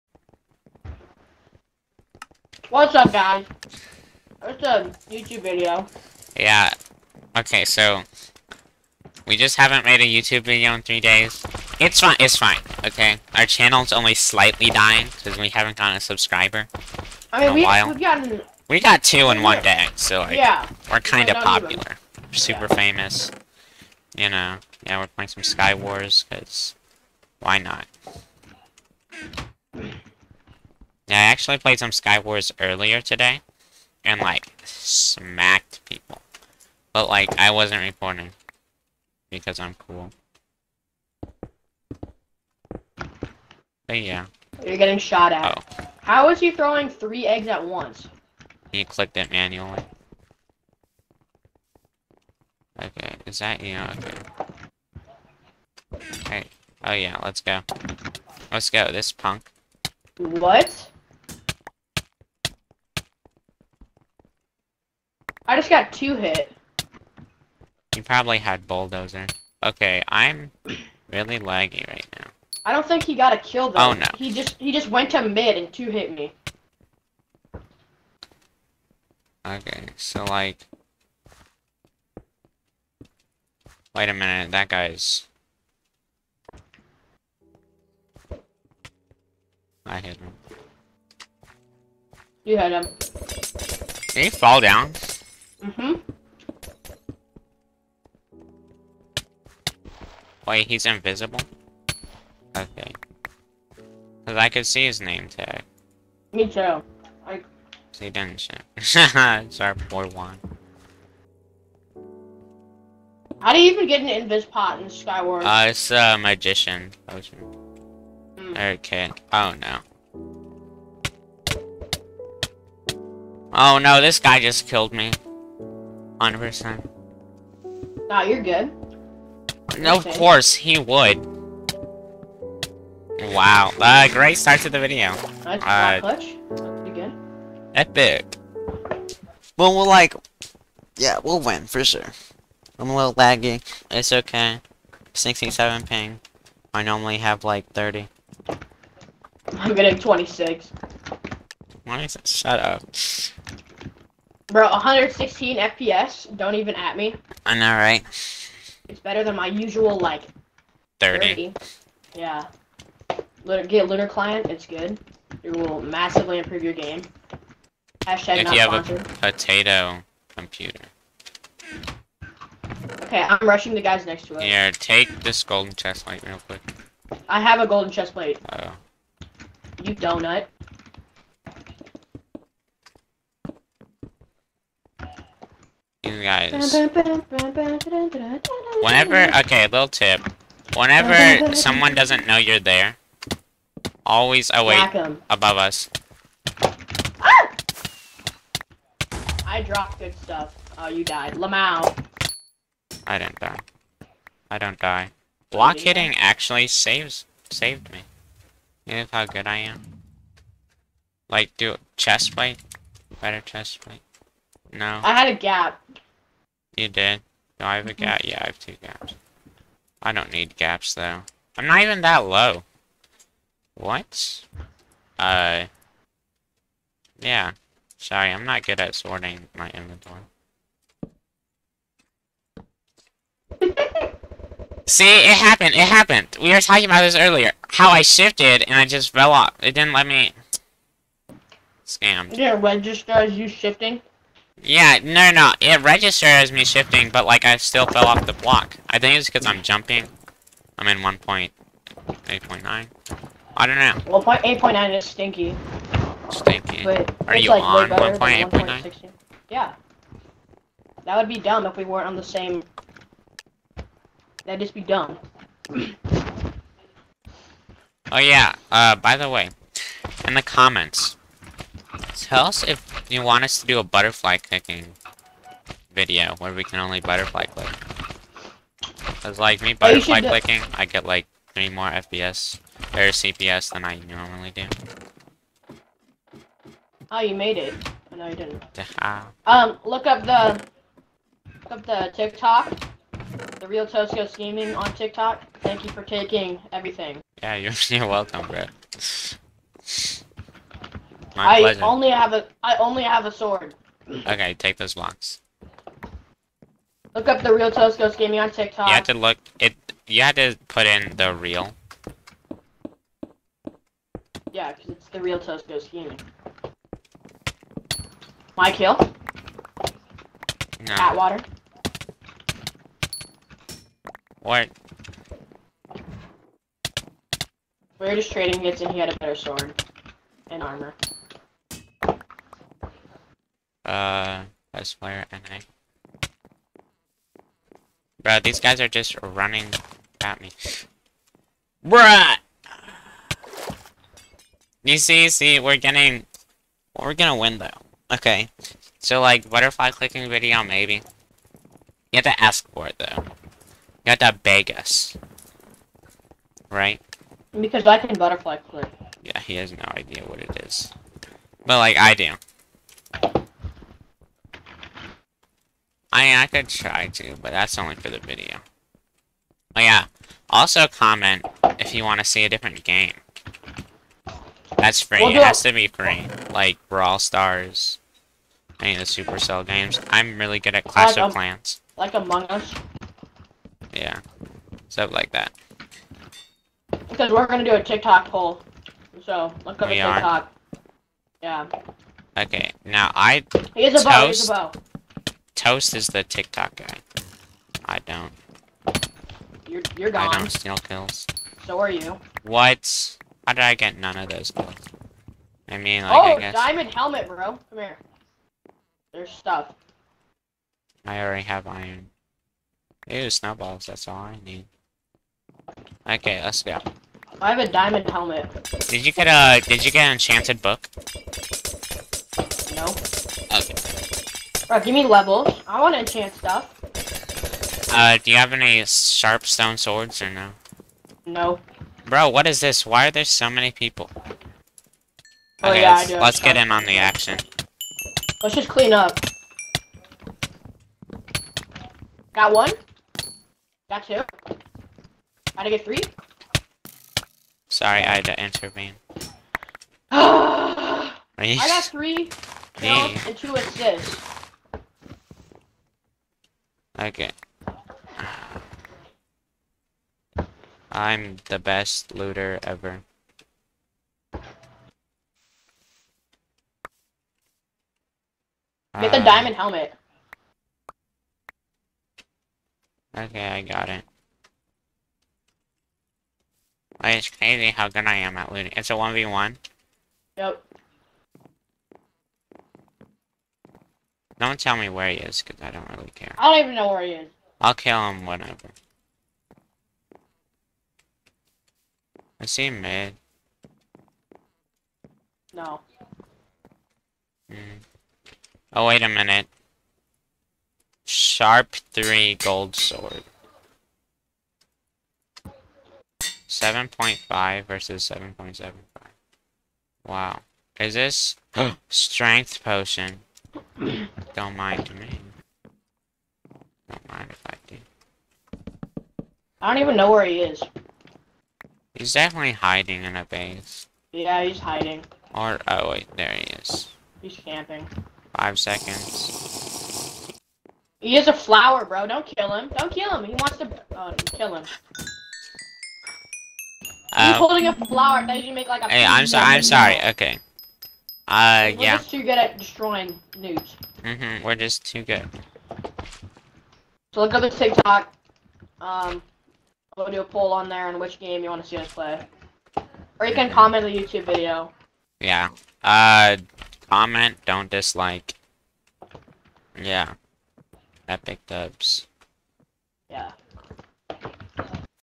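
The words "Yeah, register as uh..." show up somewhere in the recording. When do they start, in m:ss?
4:02.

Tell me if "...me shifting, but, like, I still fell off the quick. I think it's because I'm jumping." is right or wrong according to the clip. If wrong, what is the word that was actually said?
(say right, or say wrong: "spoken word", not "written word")
wrong: "block", not "quick".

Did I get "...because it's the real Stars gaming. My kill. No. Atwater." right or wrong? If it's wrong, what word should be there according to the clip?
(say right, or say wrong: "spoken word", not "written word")
wrong: "ToastGhost", not "Stars".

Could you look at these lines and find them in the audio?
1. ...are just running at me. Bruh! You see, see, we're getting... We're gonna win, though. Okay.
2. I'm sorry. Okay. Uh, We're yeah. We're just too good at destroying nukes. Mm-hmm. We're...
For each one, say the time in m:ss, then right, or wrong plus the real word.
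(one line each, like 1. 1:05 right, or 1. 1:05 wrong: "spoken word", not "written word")
1. 5:38 right
2. 8:59 right.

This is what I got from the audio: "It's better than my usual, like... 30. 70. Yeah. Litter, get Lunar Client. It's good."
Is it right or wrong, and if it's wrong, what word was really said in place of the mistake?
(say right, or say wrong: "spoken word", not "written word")
wrong: "30", not "70".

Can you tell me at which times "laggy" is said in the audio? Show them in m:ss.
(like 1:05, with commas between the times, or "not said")
1:11, 2:23.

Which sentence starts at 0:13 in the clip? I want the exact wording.
Our channel's only slightly dying, because we haven't gotten a subscriber I mean, in a we, while.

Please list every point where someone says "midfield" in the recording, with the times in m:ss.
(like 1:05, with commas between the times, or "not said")
not said.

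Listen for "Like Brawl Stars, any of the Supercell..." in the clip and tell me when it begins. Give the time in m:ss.
6:16.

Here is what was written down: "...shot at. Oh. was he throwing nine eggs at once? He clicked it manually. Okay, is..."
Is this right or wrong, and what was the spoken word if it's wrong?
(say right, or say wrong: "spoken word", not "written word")
wrong: "three", not "nine".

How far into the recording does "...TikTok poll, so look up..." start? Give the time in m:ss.
6:27.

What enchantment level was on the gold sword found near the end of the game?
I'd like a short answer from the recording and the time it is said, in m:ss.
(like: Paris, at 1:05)
3, at 8:21.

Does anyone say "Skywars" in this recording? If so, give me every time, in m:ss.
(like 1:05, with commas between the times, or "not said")
0:31, 1:54.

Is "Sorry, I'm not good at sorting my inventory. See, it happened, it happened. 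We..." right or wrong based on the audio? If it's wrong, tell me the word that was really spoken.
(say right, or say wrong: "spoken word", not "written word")
right.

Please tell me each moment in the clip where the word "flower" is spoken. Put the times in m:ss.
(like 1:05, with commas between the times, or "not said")
8:51, 8:57.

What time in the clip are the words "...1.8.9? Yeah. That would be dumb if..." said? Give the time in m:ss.
4:17.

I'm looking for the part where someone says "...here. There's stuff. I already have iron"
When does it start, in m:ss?
6:47.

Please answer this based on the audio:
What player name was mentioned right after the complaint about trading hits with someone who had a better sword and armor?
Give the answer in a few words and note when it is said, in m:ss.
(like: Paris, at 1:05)
West Flare NA, at 5:34.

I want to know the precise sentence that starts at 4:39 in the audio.
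Cause like me butterfly oh, clicking, I get like three more FPS or CPS than I normally do.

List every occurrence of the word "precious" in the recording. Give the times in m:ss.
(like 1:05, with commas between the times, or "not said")
not said.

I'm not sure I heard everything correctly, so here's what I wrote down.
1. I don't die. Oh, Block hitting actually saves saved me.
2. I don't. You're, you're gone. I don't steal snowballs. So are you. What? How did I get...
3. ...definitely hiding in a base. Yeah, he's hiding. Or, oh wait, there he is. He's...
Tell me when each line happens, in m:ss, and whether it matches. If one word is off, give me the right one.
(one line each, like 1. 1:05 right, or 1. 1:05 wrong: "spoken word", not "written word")
1. 3:24 right
2. 6:37 wrong: "kills", not "snowballs"
3. 8:42 right.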